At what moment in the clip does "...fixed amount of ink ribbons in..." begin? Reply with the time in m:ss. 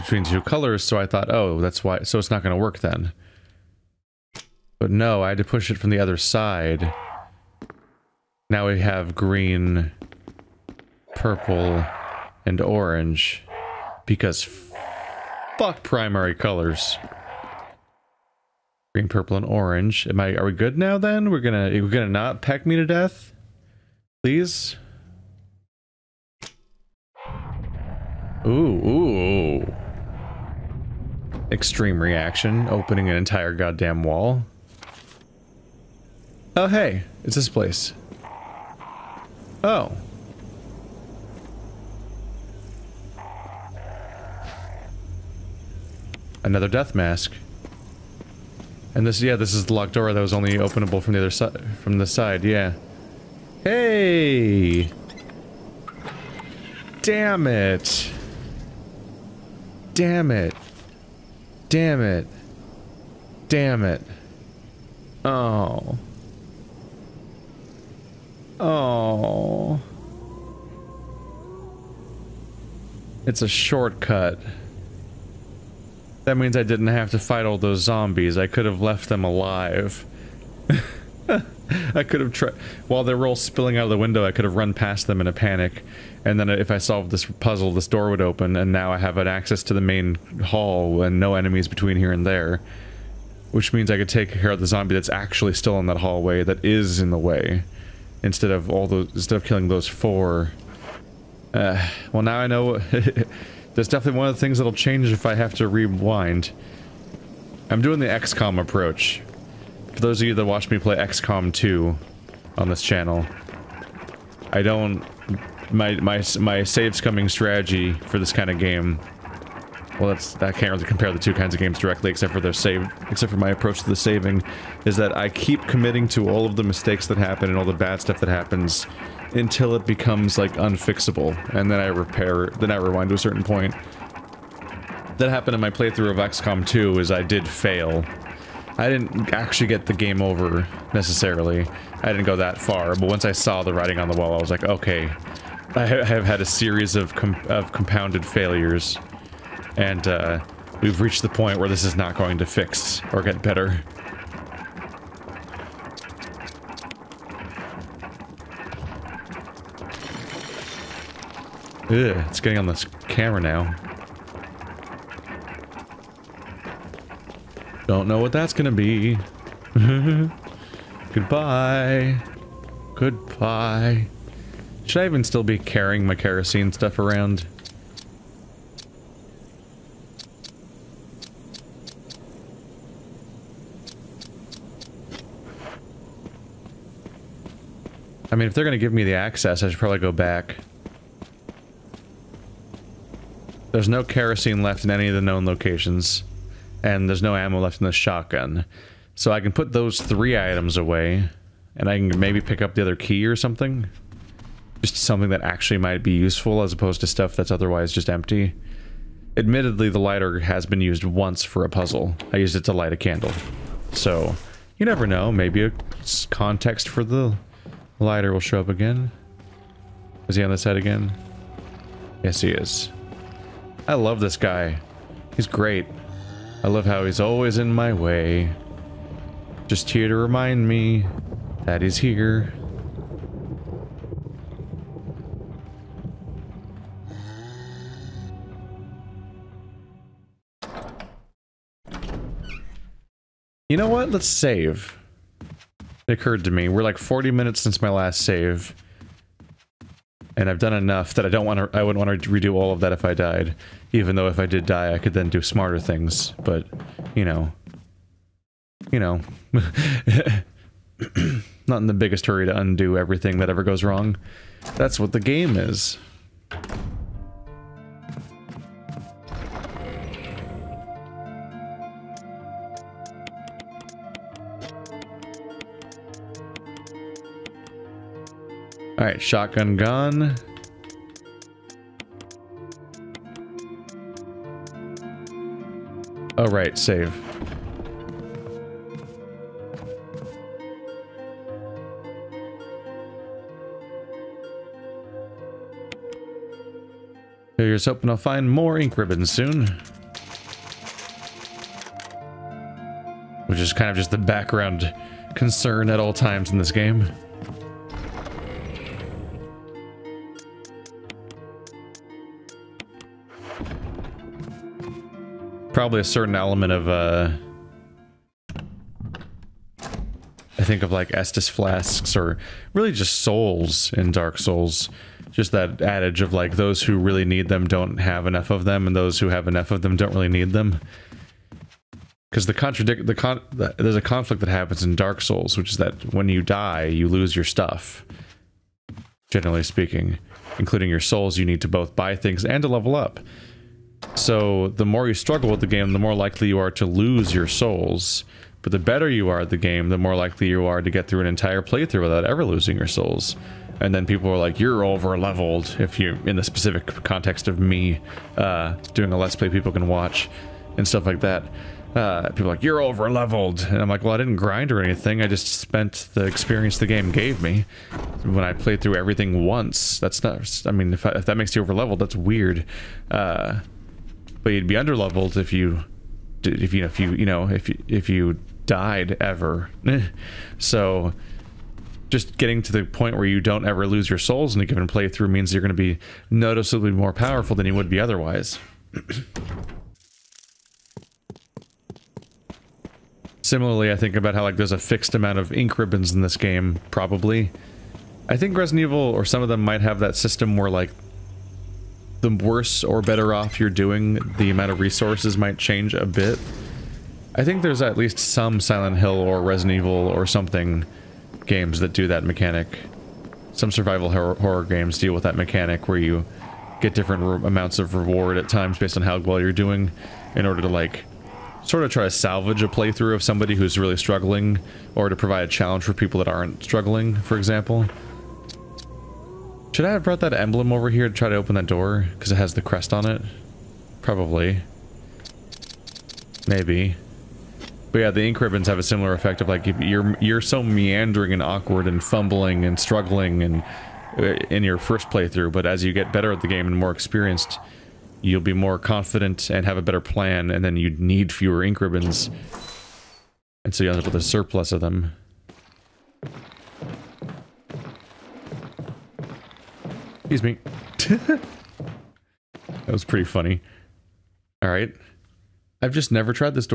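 6:34.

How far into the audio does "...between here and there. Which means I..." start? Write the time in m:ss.
1:31.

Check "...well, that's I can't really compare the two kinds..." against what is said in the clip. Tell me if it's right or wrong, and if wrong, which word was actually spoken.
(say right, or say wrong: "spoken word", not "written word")
right.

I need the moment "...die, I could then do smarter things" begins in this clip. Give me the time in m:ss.
4:14.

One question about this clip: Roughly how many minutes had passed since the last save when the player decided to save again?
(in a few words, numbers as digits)
40.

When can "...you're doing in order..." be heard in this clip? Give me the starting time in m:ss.
6:59.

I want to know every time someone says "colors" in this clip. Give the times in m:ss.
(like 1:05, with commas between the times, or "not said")
0:00, 0:16.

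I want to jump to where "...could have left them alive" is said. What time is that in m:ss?
1:18.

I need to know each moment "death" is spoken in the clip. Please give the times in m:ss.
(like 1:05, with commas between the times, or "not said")
0:22, 0:46.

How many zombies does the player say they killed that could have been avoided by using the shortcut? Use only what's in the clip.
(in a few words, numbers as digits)
4.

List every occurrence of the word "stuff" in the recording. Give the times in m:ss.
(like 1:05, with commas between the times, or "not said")
2:08, 2:56, 3:27, 5:37, 6:00.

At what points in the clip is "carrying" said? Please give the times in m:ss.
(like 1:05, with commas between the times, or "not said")
2:55.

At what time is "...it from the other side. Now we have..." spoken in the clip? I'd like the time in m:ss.
0:05.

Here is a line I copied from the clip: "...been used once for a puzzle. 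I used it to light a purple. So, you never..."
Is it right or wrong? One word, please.
wrong.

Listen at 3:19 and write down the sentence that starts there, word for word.
So I can put those three items away.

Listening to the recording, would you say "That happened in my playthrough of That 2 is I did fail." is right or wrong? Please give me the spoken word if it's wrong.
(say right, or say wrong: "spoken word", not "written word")
wrong: "XCOM", not "That".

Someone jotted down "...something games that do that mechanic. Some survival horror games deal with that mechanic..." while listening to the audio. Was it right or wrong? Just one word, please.
right.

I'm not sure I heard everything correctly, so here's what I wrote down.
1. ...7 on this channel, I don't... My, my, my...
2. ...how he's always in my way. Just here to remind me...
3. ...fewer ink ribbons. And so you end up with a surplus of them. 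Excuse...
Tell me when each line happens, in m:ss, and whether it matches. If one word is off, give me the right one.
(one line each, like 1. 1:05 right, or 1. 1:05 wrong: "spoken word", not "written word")
1. 1:51 wrong: "2", not "7"
2. 3:46 right
3. 7:31 right.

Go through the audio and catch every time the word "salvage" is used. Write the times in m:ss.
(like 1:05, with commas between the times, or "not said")
7:02.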